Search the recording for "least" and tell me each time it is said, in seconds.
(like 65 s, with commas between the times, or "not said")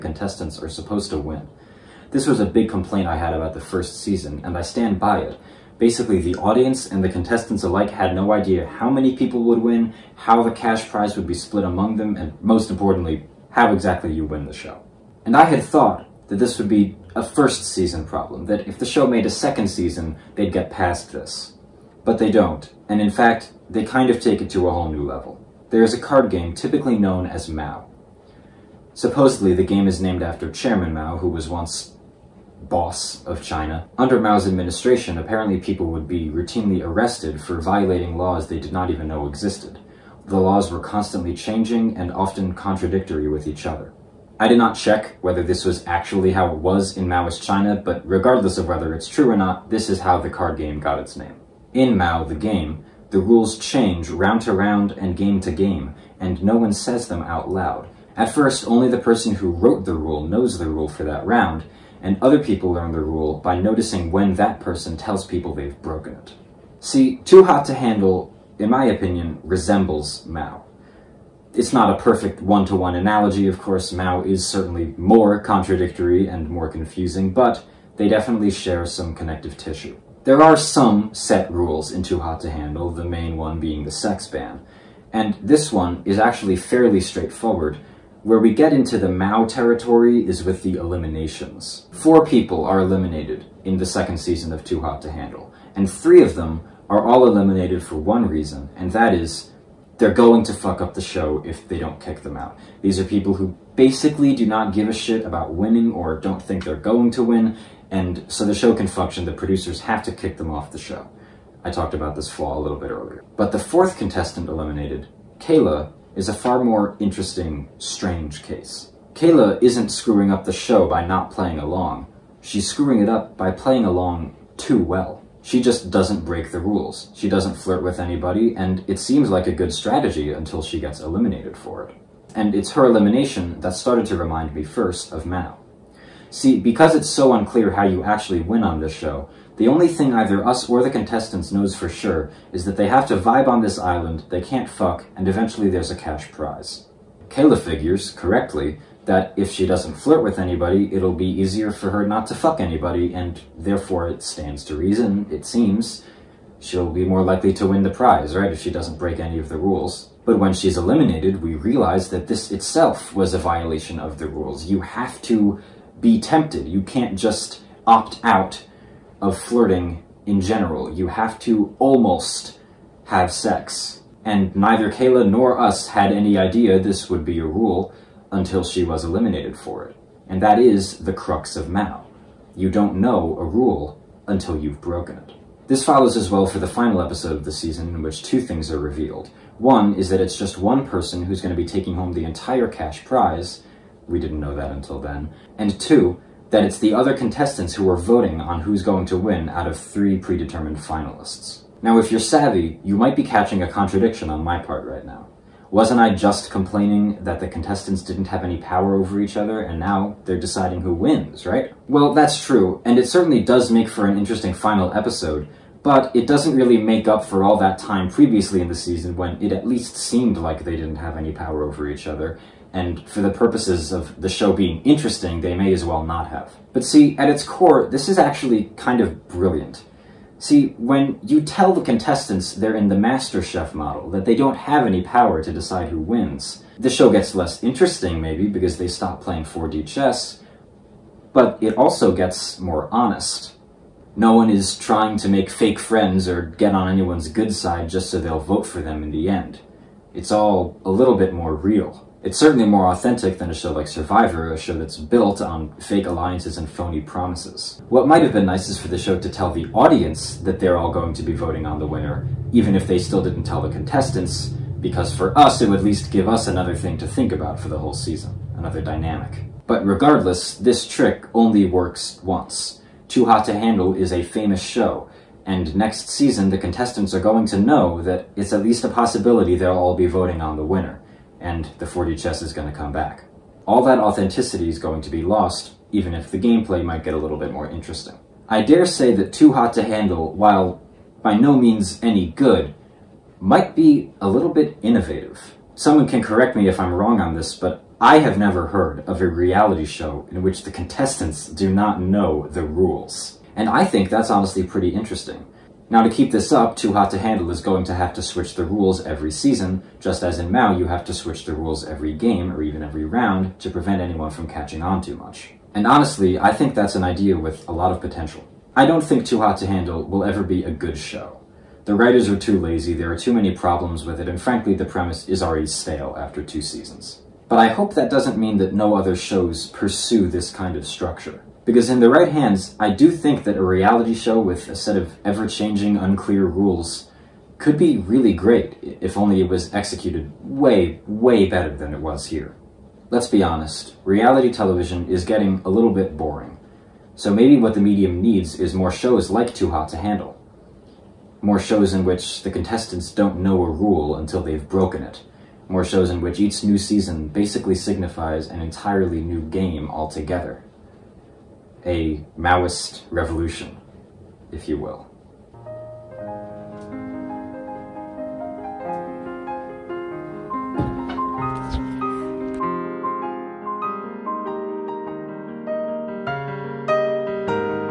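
219 s, 265 s, 278 s.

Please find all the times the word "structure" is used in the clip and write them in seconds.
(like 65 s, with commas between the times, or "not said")
330 s.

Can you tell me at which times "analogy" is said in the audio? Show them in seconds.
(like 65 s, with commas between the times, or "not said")
72 s.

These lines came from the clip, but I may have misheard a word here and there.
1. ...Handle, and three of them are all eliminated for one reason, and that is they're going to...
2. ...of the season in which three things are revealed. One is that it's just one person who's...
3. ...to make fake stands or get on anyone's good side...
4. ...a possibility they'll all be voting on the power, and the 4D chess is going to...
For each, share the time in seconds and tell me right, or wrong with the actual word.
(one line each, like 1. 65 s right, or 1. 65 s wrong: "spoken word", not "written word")
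1. 95 s right
2. 187 s wrong: "two", not "three"
3. 245 s wrong: "friends", not "stands"
4. 278 s wrong: "winner", not "power".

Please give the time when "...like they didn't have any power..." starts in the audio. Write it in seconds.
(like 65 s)
220 s.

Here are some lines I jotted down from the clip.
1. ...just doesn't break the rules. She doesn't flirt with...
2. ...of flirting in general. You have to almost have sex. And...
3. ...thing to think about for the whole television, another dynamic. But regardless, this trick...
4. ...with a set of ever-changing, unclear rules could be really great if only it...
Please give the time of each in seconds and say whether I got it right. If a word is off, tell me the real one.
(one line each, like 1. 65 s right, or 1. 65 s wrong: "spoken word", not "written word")
1. 125 s right
2. 169 s right
3. 266 s wrong: "season", not "television"
4. 334 s right.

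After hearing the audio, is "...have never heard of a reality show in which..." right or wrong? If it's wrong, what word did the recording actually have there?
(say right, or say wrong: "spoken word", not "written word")
right.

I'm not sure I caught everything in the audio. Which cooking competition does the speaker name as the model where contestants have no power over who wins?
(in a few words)
Master Chef.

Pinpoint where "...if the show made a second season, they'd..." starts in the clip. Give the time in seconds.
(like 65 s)
18 s.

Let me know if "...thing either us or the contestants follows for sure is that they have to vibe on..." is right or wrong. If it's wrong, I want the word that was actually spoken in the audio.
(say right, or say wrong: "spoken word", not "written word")
wrong: "knows", not "follows".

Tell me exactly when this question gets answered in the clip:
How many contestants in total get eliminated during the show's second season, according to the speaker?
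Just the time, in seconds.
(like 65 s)
91 s.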